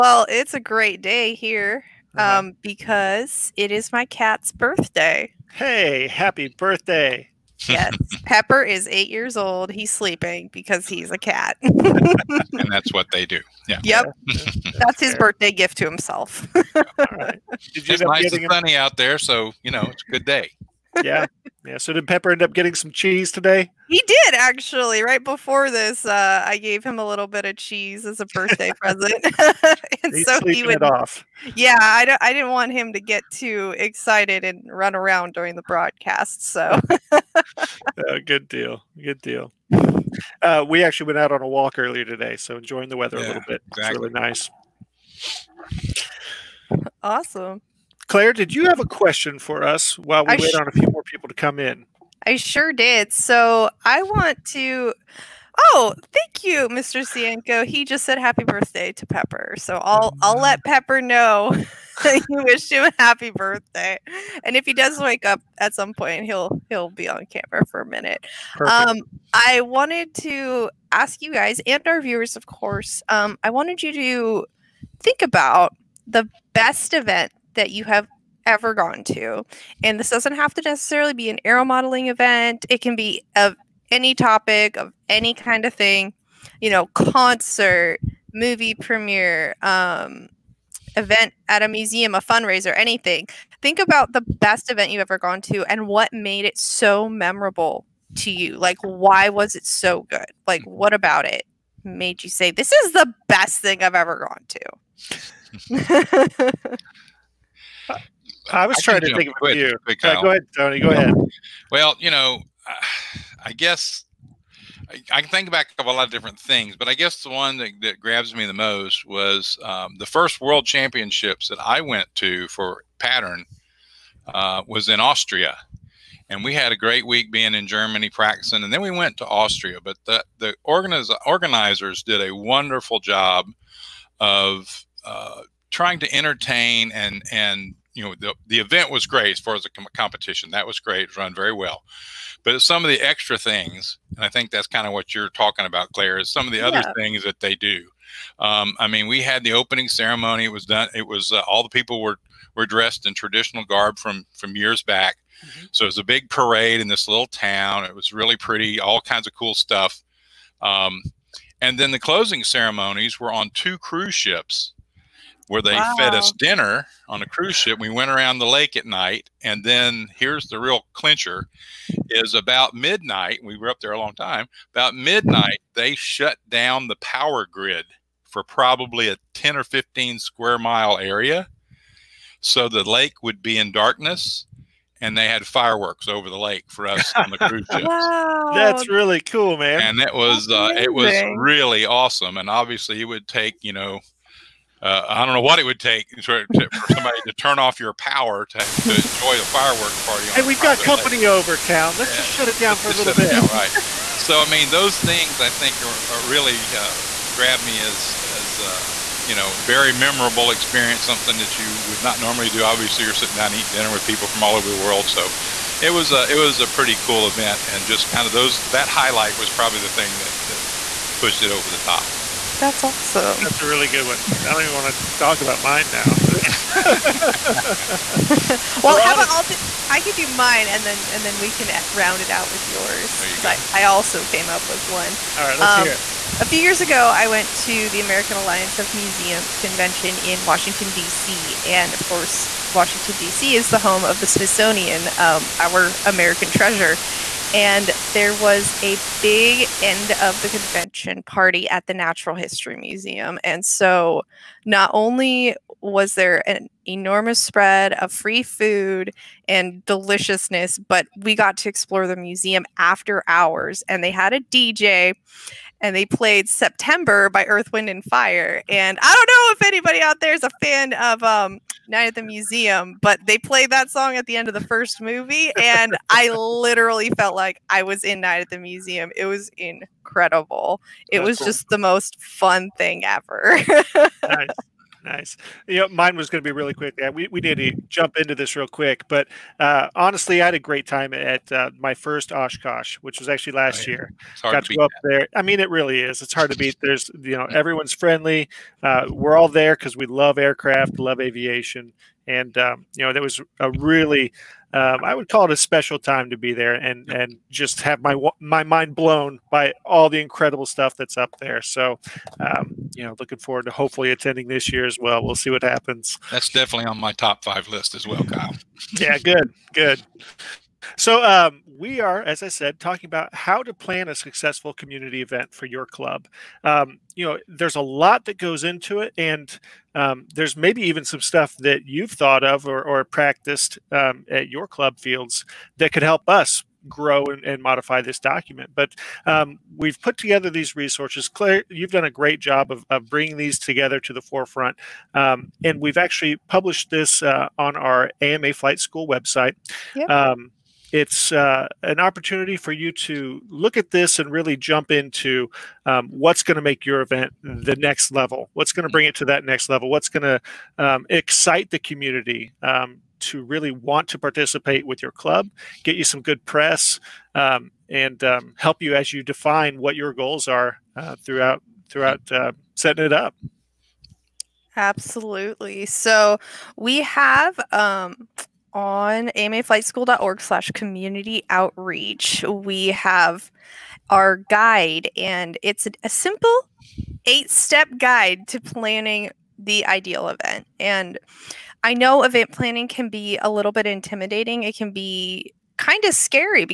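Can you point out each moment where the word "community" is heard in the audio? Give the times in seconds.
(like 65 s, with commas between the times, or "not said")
324 s, 361 s, 380 s.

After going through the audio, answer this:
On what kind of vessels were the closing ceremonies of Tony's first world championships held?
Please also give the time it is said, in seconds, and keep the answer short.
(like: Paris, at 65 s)
Cruise ships, at 163 s.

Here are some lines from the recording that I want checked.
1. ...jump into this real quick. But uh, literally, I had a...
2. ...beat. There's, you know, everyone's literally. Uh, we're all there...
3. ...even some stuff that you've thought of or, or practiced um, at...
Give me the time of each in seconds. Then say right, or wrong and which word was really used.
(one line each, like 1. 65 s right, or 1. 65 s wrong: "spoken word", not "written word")
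1. 287 s wrong: "honestly", not "literally"
2. 296 s wrong: "friendly", not "literally"
3. 330 s right.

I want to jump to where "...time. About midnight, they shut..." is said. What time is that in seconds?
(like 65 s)
174 s.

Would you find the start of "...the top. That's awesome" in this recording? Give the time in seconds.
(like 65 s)
221 s.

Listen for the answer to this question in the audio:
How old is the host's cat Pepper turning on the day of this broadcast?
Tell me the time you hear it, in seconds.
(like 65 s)
8 s.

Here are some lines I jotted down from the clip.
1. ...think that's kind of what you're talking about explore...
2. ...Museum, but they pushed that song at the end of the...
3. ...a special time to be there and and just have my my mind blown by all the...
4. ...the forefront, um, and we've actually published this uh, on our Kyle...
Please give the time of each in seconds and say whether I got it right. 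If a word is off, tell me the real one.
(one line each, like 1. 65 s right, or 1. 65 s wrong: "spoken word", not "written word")
1. 144 s wrong: "claire", not "explore"
2. 272 s wrong: "played", not "pushed"
3. 305 s right
4. 344 s wrong: "AMA", not "Kyle".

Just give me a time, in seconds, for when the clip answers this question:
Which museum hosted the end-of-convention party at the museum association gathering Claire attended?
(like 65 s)
251 s.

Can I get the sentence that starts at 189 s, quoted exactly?
And it was uh, it was really awesome.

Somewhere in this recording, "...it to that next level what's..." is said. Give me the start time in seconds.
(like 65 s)
359 s.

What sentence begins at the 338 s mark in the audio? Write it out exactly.
But um, we've put together these resources.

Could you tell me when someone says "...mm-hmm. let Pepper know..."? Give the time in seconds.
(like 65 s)
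60 s.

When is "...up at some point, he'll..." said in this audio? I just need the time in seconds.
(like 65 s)
65 s.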